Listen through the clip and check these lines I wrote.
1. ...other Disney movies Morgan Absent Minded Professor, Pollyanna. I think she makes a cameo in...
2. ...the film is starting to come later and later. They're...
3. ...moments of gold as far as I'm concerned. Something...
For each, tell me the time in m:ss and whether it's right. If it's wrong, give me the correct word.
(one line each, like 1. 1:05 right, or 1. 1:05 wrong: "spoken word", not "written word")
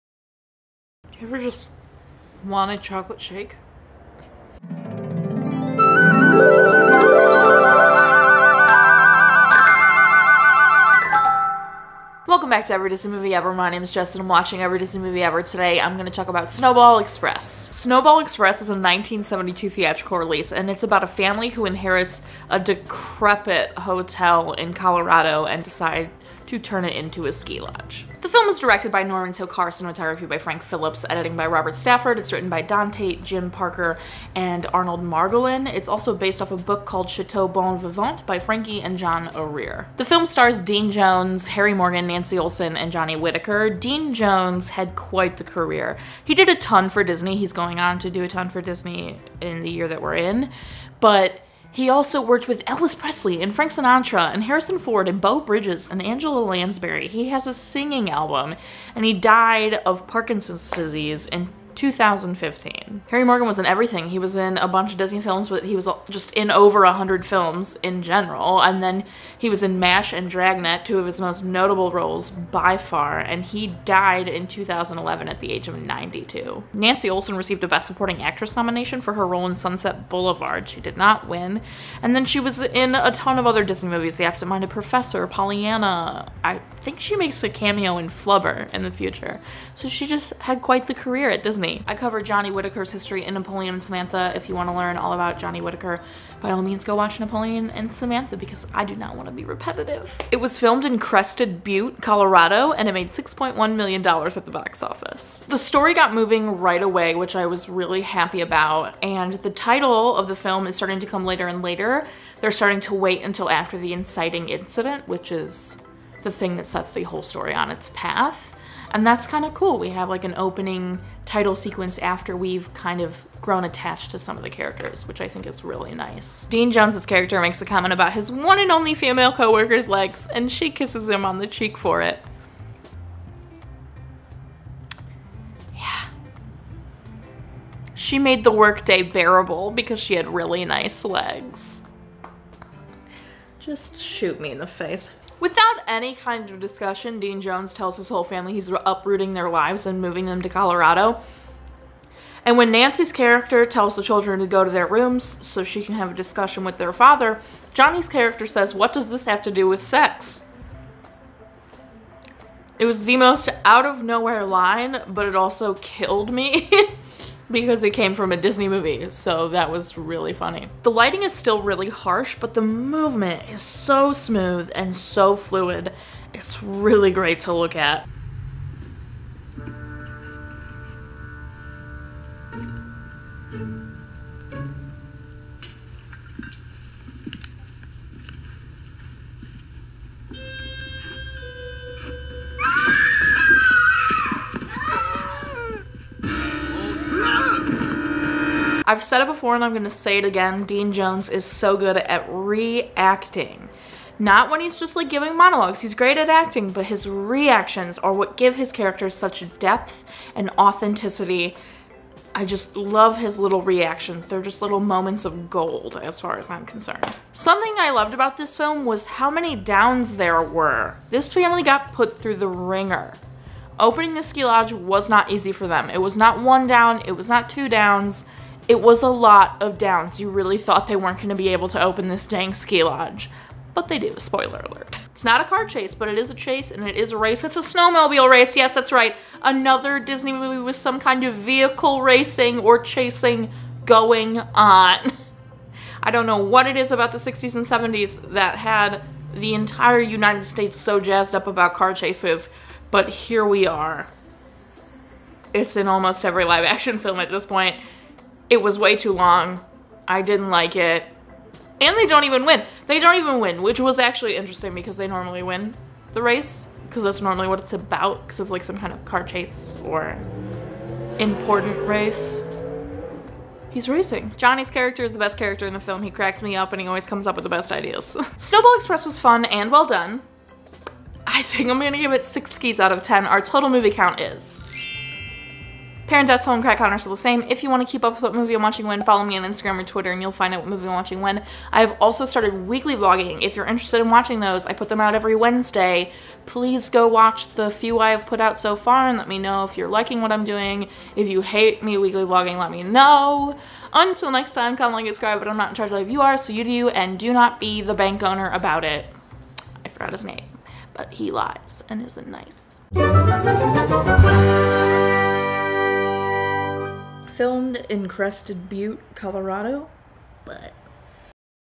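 1. 1:23 wrong: "The", not "Morgan"
2. 1:50 right
3. 3:34 right.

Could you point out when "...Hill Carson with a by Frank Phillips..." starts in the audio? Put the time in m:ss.
0:29.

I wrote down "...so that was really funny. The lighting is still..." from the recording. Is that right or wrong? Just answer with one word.
right.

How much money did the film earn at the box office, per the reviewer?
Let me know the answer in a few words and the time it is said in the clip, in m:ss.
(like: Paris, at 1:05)
$6.1 million, at 1:43.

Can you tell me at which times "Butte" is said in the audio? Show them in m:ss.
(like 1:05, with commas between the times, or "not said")
1:41, 5:18.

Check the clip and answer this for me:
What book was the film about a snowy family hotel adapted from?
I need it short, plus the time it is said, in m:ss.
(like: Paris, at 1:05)
Chateau Bon Vivant, at 0:37.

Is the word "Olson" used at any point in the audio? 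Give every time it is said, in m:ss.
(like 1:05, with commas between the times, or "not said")
0:42, 1:17.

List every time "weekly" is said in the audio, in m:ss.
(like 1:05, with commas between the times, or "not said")
4:52, 5:01.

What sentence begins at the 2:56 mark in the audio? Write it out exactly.
It's really great to look at.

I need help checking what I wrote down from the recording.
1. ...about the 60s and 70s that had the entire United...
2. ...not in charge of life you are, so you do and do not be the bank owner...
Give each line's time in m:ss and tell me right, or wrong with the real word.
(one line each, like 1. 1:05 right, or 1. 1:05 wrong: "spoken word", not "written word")
1. 4:06 right
2. 5:05 right.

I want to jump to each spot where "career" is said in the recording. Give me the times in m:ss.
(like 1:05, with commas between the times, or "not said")
0:45, 1:30.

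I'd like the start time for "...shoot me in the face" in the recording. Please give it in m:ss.
2:23.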